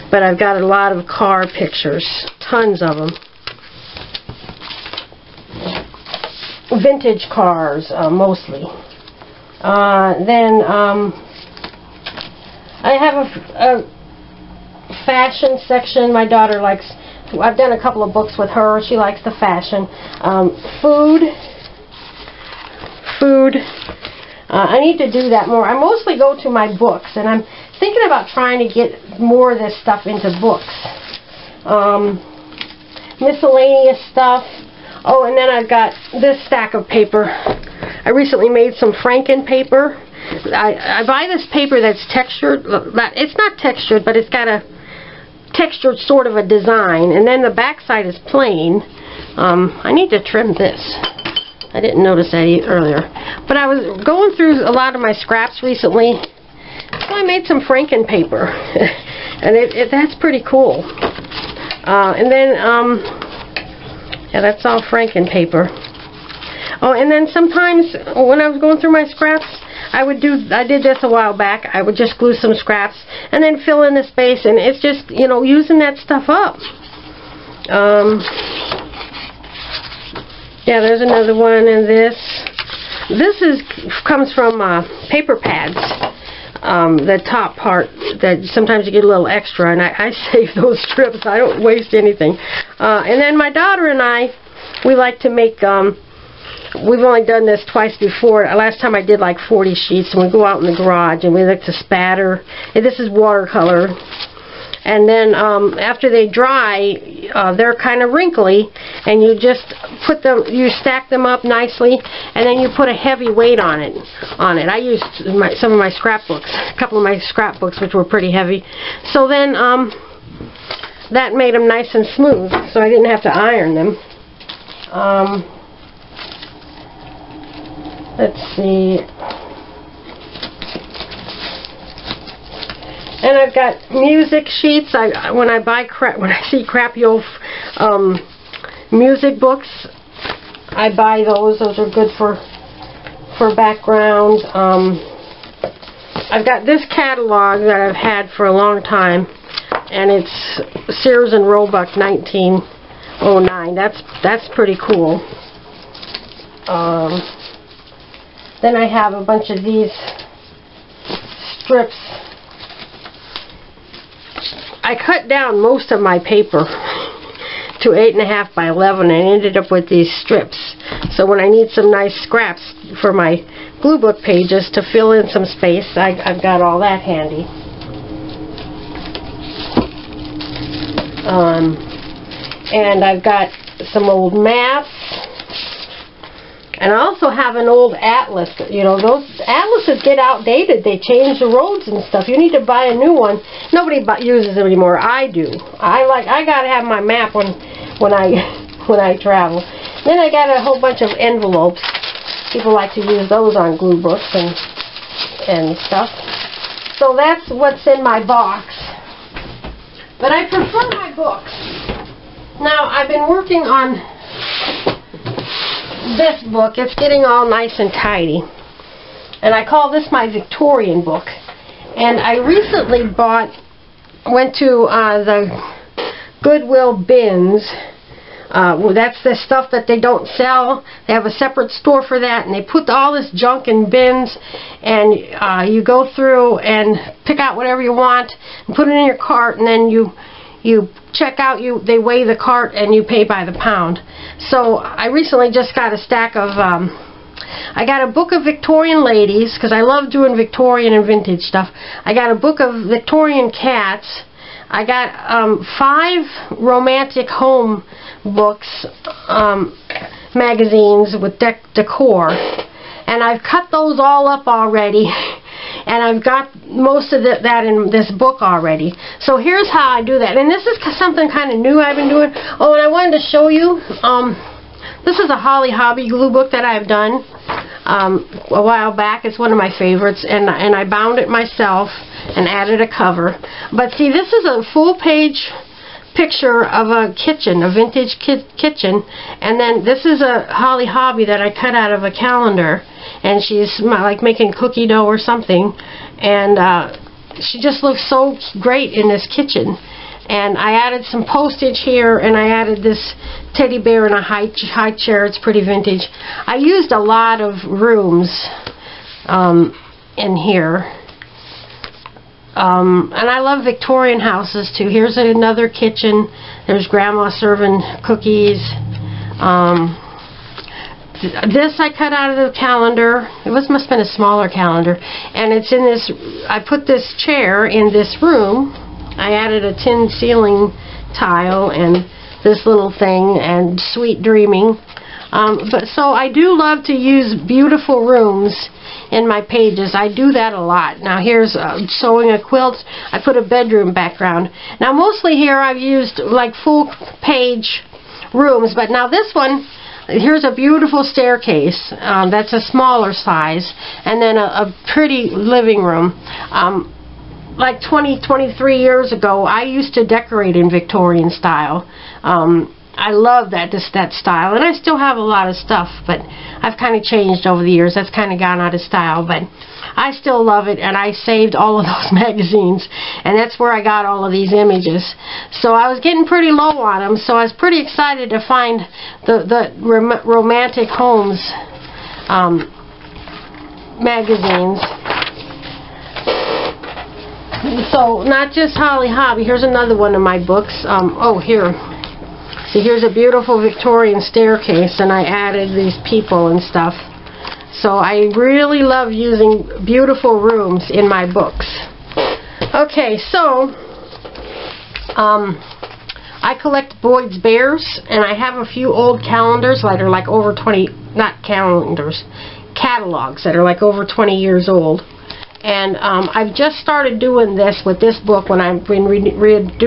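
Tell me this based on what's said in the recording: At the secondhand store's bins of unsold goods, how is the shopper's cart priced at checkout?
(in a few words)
By the pound.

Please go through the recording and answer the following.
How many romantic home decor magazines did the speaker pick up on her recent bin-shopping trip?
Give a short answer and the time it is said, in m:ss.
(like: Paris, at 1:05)
5, at 4:15.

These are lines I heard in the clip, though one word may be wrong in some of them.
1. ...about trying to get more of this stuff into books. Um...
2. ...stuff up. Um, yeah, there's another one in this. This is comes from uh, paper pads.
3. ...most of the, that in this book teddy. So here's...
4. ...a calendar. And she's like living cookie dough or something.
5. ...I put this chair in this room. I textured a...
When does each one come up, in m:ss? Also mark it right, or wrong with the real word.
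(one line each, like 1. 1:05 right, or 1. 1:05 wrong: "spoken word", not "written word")
1. 0:28 right
2. 1:15 right
3. 4:26 wrong: "already", not "teddy"
4. 4:52 wrong: "making", not "living"
5. 5:26 wrong: "added", not "textured".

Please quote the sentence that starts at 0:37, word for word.
I recently made some Franken paper.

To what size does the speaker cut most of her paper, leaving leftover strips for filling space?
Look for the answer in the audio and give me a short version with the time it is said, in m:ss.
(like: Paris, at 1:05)
8.5 by 11, at 2:47.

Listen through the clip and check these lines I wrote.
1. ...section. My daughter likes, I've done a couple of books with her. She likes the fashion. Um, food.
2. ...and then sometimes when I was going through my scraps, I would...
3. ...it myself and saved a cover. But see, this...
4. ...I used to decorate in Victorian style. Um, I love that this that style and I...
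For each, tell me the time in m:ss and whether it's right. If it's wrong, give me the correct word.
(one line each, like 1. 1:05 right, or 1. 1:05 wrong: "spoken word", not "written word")
1. 0:15 right
2. 1:06 right
3. 4:41 wrong: "added", not "saved"
4. 5:59 right.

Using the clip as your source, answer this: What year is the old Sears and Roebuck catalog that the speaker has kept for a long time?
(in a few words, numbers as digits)
1909.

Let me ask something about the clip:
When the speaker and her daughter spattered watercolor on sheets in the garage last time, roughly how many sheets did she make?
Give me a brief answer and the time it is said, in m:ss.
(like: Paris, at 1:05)
40, at 1:39.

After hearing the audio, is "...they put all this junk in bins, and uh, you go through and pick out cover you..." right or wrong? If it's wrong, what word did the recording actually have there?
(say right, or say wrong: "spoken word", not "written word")
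wrong: "whatever", not "cover".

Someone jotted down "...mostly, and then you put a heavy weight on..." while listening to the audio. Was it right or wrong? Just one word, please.
wrong.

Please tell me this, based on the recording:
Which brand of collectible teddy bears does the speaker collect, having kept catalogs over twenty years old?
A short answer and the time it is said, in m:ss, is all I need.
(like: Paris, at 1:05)
Boyd's Bears, at 6:47.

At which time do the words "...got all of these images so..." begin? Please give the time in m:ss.
6:13.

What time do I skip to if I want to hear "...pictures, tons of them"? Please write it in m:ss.
0:01.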